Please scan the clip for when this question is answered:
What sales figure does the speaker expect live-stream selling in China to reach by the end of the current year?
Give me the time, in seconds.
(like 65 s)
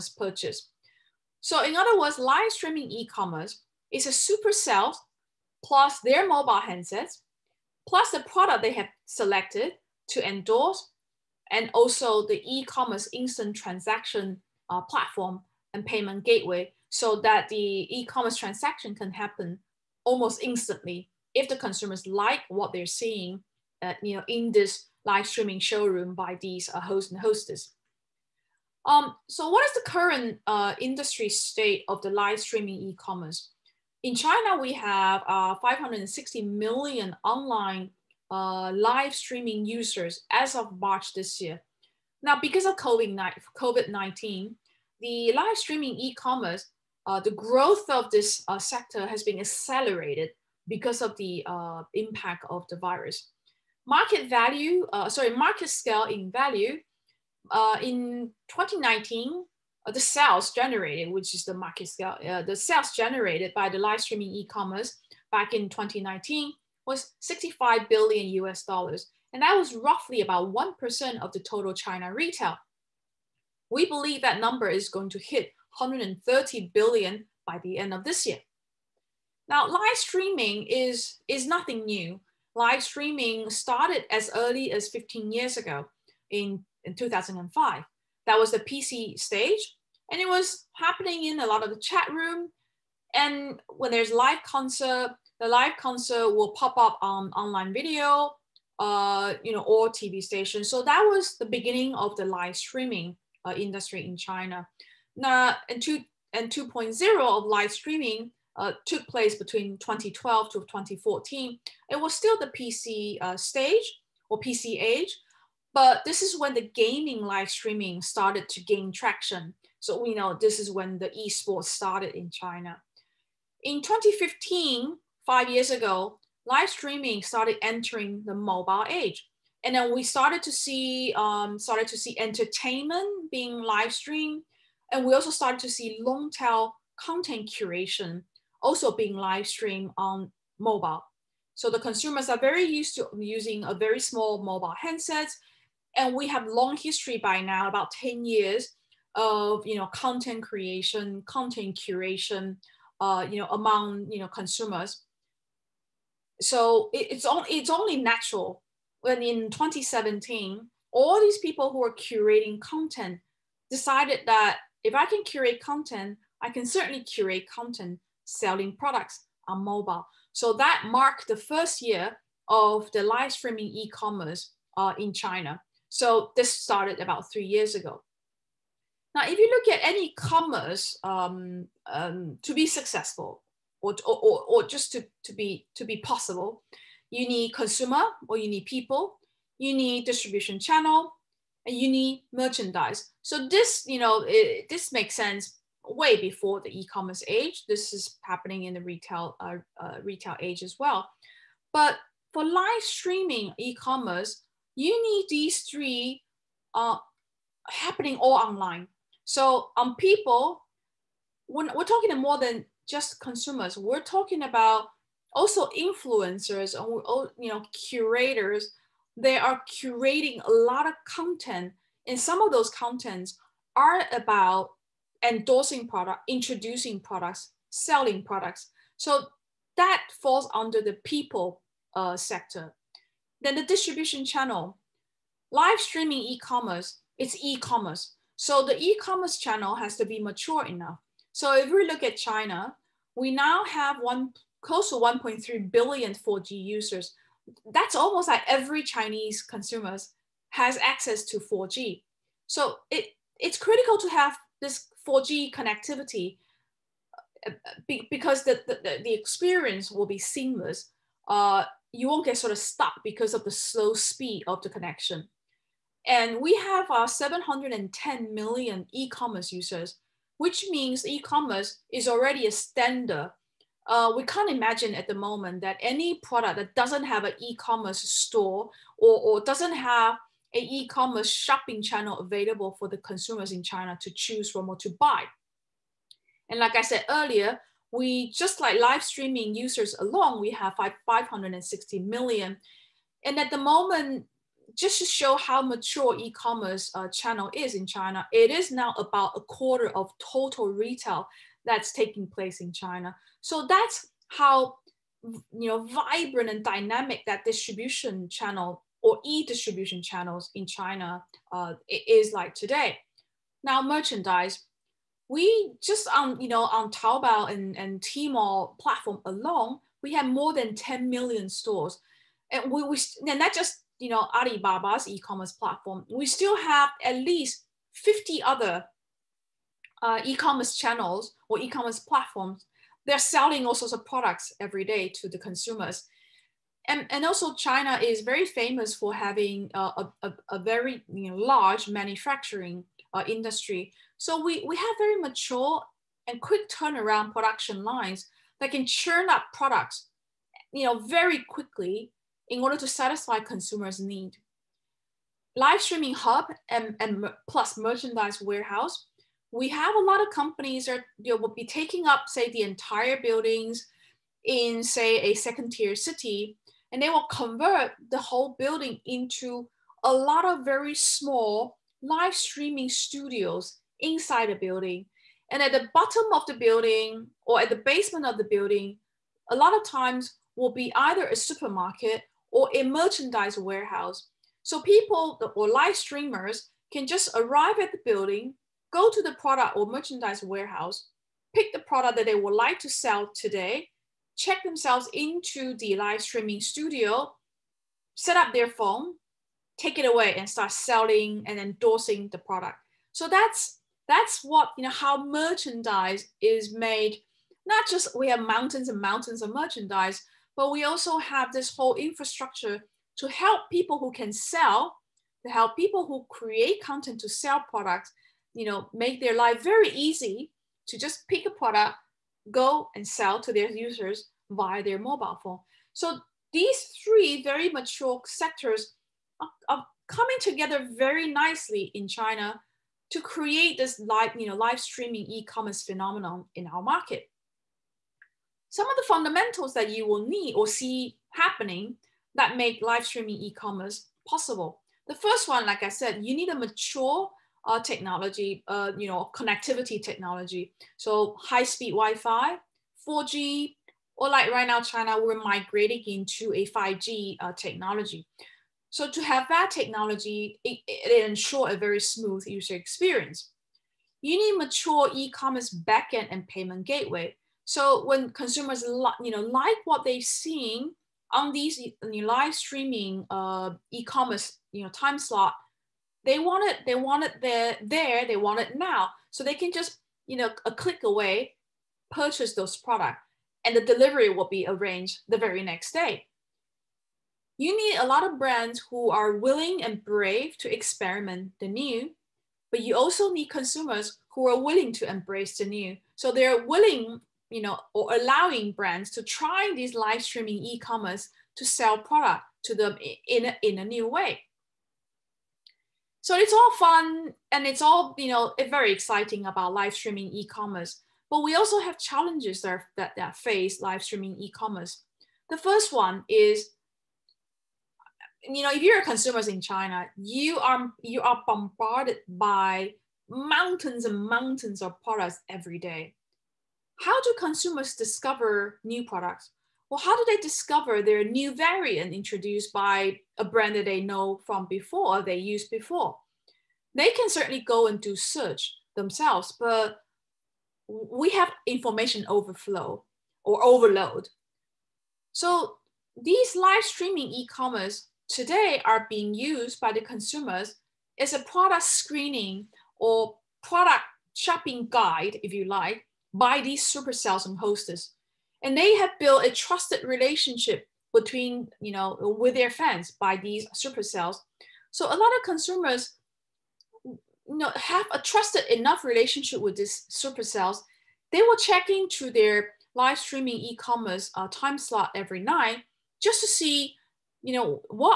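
75 s.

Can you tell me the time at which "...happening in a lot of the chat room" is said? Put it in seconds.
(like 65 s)
90 s.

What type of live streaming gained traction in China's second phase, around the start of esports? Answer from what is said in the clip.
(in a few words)
gaming live streaming.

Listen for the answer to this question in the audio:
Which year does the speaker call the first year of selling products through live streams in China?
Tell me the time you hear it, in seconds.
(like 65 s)
159 s.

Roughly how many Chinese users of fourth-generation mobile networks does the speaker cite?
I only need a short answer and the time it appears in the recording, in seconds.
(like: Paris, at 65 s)
1.3 billion, at 244 s.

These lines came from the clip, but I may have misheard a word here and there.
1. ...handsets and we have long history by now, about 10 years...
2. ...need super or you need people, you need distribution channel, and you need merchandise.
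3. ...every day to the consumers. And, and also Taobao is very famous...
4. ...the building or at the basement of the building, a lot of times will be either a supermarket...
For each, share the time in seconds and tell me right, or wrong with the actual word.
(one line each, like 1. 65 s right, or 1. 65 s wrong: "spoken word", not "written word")
1. 144 s right
2. 187 s wrong: "consumer", not "super"
3. 334 s wrong: "China", not "Taobao"
4. 376 s right.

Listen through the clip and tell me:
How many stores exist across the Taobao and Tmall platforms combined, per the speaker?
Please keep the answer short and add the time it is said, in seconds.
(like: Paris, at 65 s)
more than 10 million, at 320 s.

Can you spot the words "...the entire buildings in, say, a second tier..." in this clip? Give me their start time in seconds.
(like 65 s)
362 s.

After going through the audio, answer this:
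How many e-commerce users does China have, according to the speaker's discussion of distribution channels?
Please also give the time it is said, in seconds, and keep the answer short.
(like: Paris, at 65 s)
710 million, at 267 s.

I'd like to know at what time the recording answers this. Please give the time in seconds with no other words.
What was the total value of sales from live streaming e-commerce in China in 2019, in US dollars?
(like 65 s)
67 s.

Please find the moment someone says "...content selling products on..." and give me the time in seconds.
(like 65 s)
167 s.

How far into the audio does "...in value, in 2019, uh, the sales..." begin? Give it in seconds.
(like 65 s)
56 s.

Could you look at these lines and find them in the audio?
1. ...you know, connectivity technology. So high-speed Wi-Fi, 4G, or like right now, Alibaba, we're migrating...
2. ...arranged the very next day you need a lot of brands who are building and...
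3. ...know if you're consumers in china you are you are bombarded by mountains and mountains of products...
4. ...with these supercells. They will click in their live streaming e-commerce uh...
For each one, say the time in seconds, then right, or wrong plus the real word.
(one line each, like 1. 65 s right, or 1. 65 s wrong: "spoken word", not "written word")
1. 448 s wrong: "China", not "Alibaba"
2. 484 s wrong: "willing", not "building"
3. 518 s right
4. 569 s wrong: "check", not "click".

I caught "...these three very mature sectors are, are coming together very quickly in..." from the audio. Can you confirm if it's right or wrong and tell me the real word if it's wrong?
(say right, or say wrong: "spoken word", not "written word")
wrong: "nicely", not "quickly".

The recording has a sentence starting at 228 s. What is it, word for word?
So that falls under the people uh, sector then the distribution channel, live streaming e-commerce, it's e-commerce.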